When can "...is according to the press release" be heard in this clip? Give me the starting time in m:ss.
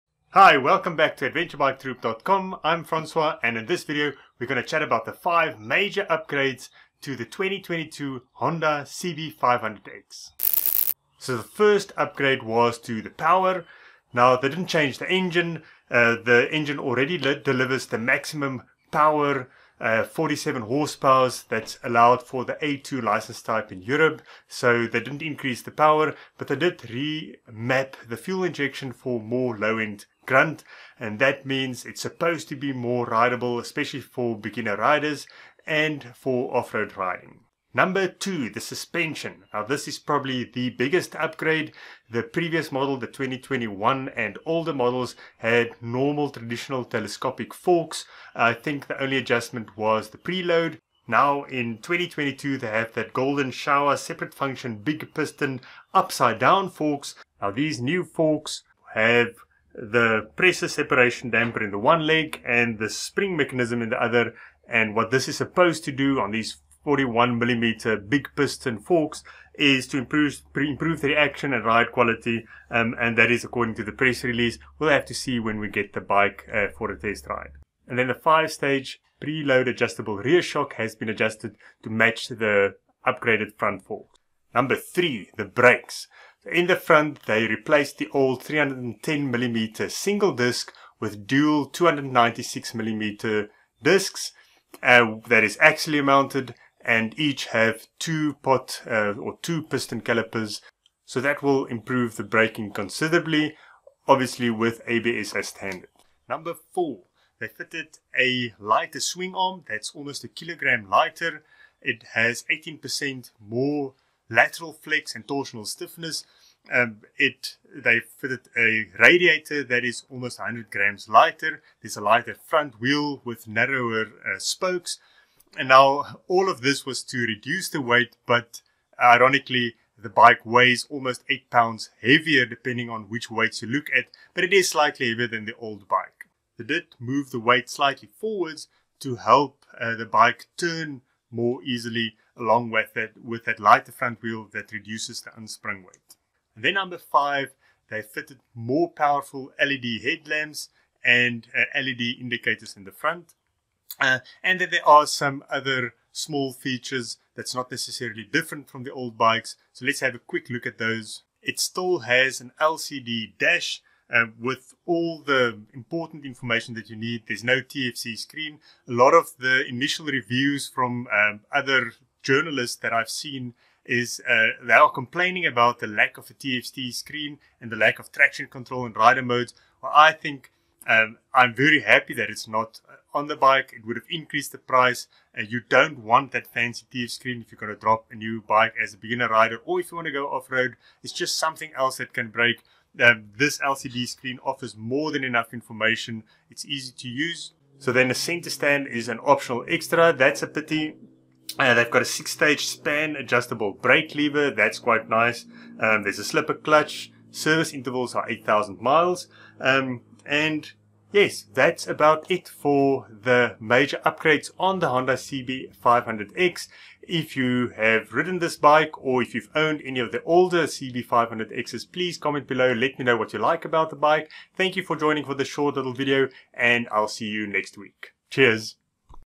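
1:13.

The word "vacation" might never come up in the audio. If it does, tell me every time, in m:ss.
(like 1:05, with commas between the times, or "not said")
not said.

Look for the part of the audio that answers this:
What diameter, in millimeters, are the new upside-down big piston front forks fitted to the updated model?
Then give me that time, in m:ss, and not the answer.
1:06.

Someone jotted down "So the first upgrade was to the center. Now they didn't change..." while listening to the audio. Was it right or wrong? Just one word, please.
wrong.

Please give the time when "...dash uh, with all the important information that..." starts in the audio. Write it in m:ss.
2:43.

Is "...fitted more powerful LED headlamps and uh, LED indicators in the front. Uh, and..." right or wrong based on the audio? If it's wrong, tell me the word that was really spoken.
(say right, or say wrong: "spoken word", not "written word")
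right.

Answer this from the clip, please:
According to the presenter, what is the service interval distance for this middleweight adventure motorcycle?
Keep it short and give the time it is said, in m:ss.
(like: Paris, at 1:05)
8,000 miles, at 3:28.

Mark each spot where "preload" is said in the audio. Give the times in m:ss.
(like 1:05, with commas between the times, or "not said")
0:50, 1:19.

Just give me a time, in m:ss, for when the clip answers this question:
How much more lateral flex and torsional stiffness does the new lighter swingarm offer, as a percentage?
1:52.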